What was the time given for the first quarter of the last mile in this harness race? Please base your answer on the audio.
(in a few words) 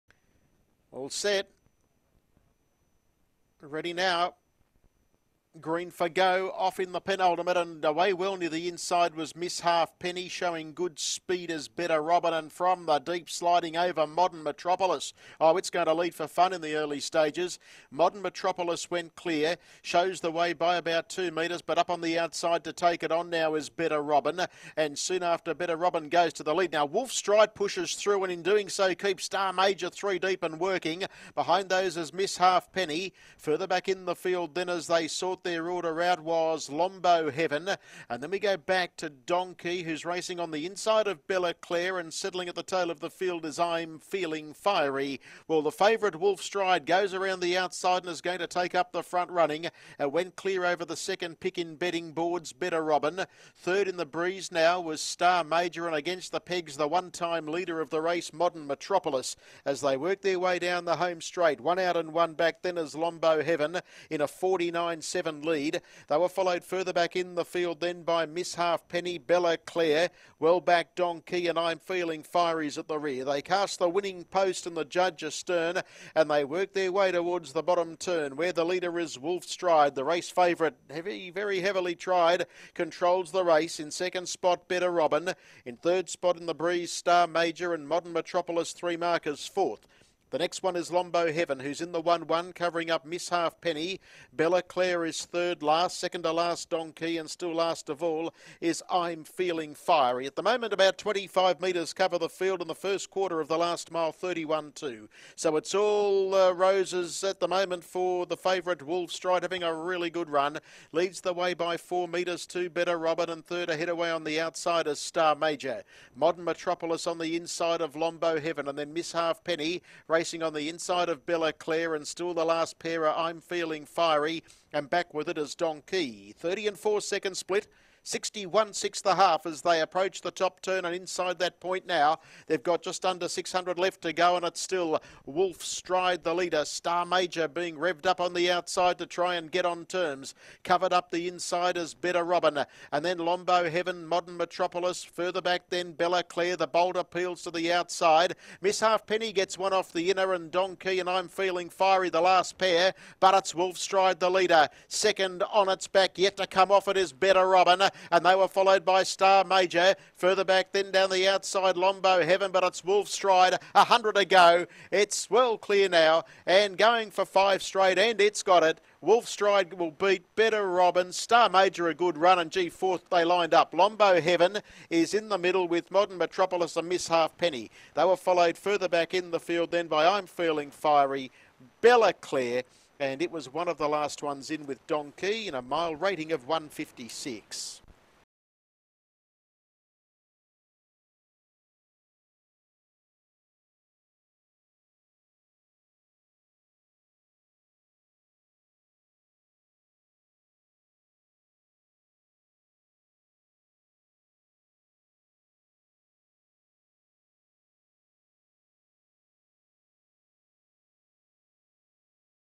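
31.2.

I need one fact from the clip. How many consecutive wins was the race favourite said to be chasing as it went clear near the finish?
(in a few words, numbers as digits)
5.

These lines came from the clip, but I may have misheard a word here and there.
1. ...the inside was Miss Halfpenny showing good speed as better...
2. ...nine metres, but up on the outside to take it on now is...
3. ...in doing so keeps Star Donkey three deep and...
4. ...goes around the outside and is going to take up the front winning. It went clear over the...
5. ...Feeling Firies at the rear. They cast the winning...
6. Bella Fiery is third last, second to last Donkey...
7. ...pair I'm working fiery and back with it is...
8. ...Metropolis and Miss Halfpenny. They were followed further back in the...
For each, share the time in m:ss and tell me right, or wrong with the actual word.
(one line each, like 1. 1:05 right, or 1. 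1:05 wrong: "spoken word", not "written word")
1. 0:08 right
2. 0:21 wrong: "two", not "nine"
3. 0:28 wrong: "Major", not "Donkey"
4. 0:46 wrong: "running", not "winning"
5. 1:11 right
6. 1:34 wrong: "Clare", not "Fiery"
7. 2:02 wrong: "feeling", not "working"
8. 2:56 right.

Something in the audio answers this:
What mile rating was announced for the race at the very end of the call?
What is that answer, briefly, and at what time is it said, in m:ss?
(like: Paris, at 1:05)
156, at 3:06.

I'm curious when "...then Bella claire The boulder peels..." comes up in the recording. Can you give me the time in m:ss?
2:25.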